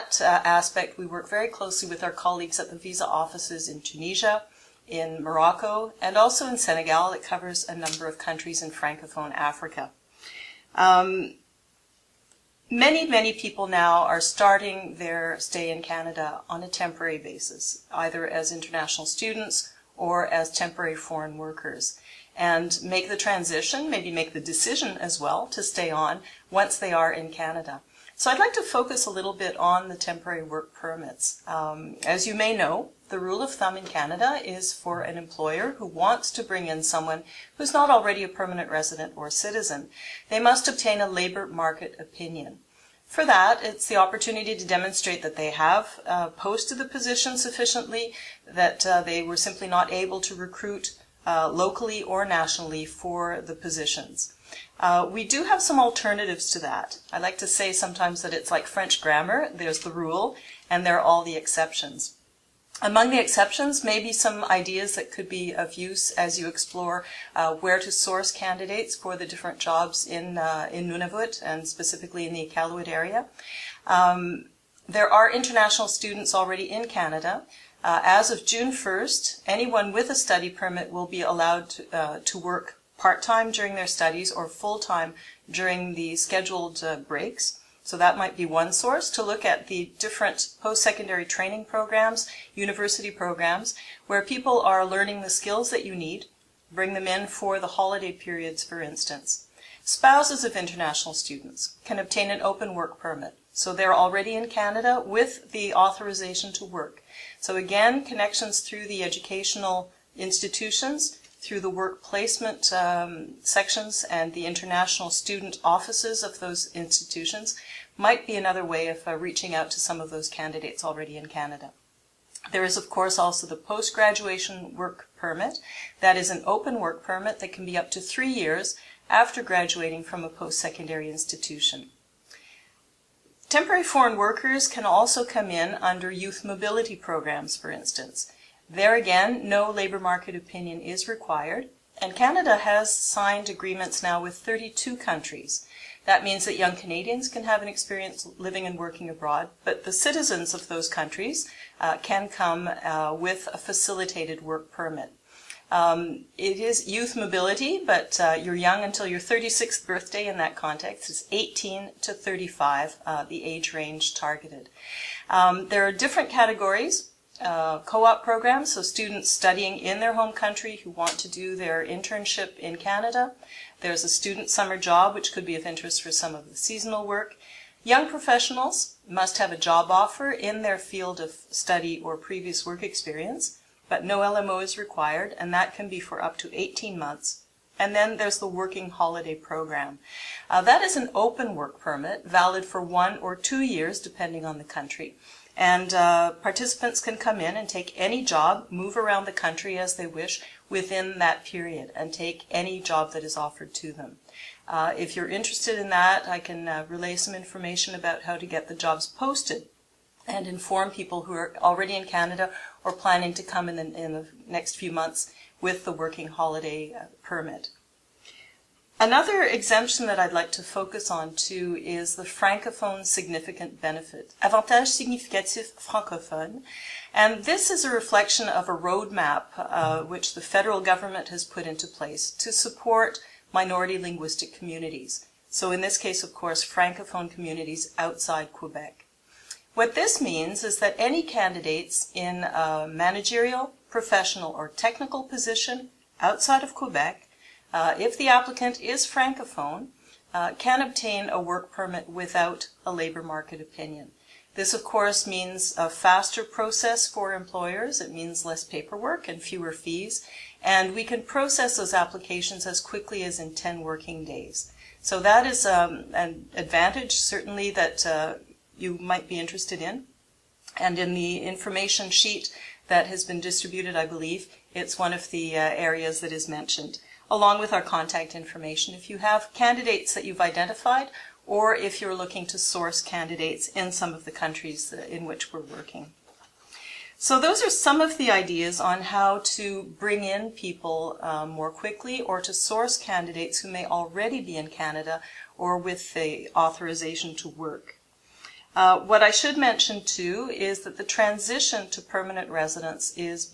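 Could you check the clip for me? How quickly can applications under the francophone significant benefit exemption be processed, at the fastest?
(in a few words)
10 working days.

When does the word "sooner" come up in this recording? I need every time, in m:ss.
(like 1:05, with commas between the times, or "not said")
not said.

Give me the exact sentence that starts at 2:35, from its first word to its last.
Um, it is youth mobility, but uh, you're young until your 36th birthday in that context.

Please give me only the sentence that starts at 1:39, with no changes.
Spouses of international students can obtain an open work permit.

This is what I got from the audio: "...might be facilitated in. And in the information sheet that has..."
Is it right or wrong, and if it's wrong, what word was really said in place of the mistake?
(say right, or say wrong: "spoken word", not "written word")
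wrong: "interested", not "facilitated".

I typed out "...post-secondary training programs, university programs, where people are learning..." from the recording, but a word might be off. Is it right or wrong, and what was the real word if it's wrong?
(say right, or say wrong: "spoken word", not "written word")
right.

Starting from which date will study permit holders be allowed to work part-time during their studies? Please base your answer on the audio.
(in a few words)
June 1st.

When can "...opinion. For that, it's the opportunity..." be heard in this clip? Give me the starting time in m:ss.
0:41.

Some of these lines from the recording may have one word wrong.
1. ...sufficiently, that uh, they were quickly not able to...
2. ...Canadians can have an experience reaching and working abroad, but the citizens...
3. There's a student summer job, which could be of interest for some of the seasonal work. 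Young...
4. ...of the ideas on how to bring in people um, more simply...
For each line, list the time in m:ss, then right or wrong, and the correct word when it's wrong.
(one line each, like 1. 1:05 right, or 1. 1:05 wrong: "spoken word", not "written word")
1. 0:47 wrong: "simply", not "quickly"
2. 2:26 wrong: "living", not "reaching"
3. 2:53 right
4. 4:48 wrong: "quickly", not "simply".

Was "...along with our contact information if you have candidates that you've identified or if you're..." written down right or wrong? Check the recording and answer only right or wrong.
right.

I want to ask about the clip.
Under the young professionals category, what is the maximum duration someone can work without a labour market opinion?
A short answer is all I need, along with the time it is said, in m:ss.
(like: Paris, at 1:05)
18 months, at 3:06.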